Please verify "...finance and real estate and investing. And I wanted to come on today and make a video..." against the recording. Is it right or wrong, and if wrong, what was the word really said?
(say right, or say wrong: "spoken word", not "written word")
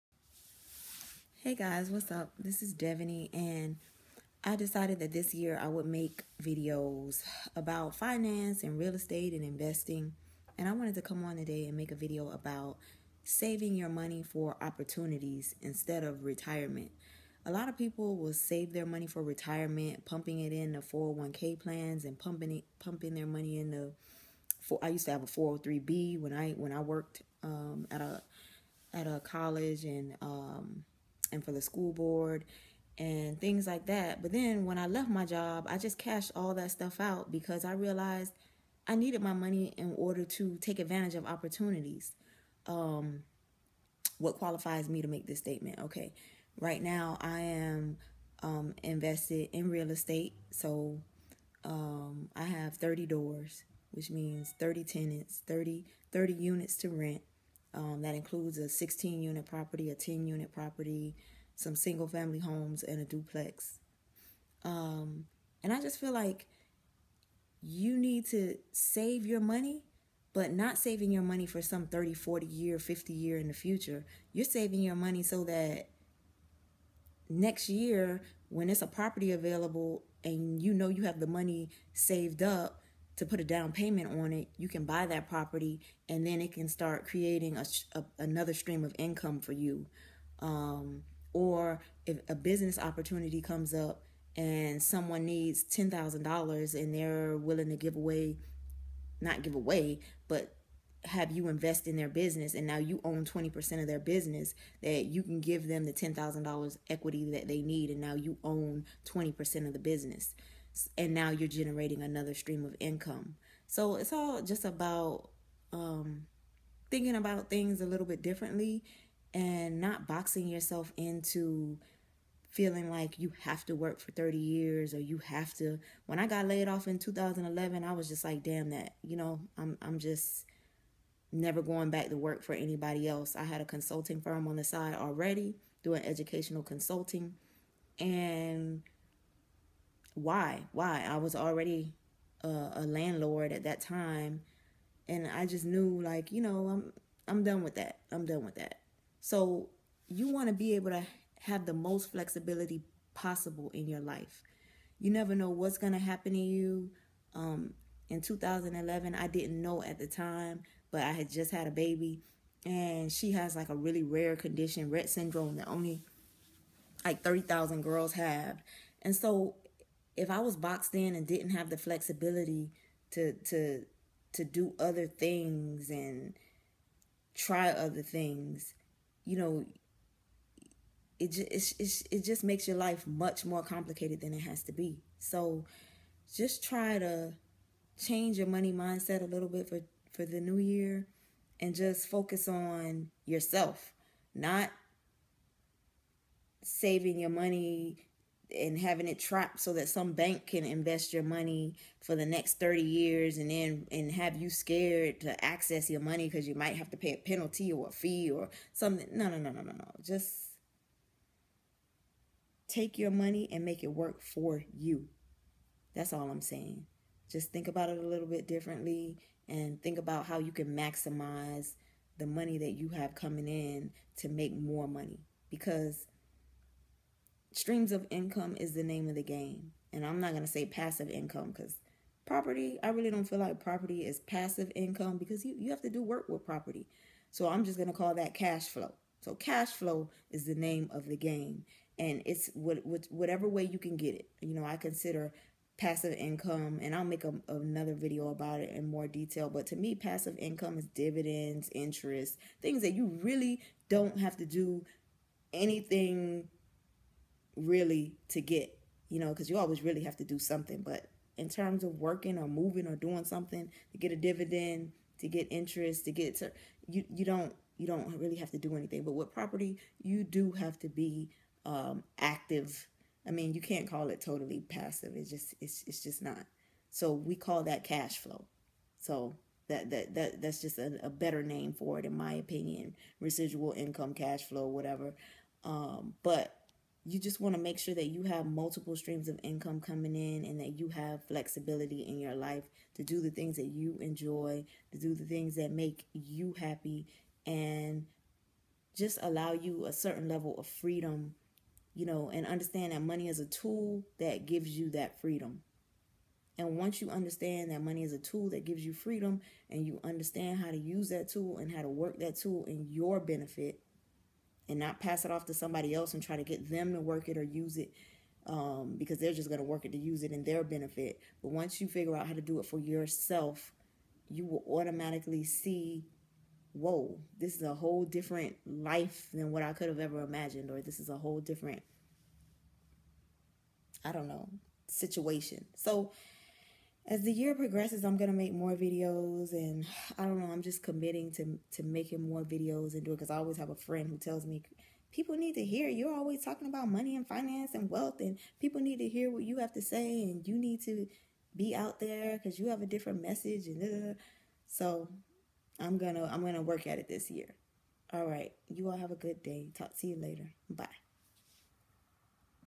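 right.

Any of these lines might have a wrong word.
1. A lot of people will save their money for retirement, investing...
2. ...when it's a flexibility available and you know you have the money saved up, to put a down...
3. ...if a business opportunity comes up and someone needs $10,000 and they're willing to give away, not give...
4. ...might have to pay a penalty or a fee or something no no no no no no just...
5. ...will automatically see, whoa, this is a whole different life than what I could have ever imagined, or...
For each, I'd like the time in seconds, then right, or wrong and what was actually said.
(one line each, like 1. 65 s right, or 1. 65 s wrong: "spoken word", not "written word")
1. 17 s wrong: "pumping", not "investing"
2. 78 s wrong: "property", not "flexibility"
3. 92 s right
4. 206 s right
5. 324 s right.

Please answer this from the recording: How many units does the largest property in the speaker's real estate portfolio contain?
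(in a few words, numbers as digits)
16.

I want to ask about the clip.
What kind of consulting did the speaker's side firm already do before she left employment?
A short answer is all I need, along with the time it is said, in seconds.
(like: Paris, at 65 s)
educational consulting, at 136 s.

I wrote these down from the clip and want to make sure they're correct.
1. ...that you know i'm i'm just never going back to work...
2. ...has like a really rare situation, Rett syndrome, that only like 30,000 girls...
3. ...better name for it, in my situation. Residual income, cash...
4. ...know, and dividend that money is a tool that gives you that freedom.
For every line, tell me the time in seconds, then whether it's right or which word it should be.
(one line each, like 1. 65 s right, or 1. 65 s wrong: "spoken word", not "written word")
1. 128 s right
2. 163 s wrong: "condition", not "situation"
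3. 281 s wrong: "opinion", not "situation"
4. 302 s wrong: "understand", not "dividend".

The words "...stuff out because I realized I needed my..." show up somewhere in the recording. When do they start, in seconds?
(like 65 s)
36 s.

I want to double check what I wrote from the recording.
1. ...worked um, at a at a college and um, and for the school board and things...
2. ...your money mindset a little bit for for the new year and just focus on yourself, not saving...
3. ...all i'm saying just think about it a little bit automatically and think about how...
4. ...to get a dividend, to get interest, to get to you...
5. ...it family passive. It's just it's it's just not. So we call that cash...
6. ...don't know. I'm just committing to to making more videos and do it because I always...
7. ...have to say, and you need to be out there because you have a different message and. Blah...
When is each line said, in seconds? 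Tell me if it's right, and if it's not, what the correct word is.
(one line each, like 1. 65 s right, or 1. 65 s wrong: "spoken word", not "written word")
1. 26 s right
2. 188 s right
3. 216 s wrong: "differently", not "automatically"
4. 263 s right
5. 274 s wrong: "totally", not "family"
6. 340 s right
7. 349 s right.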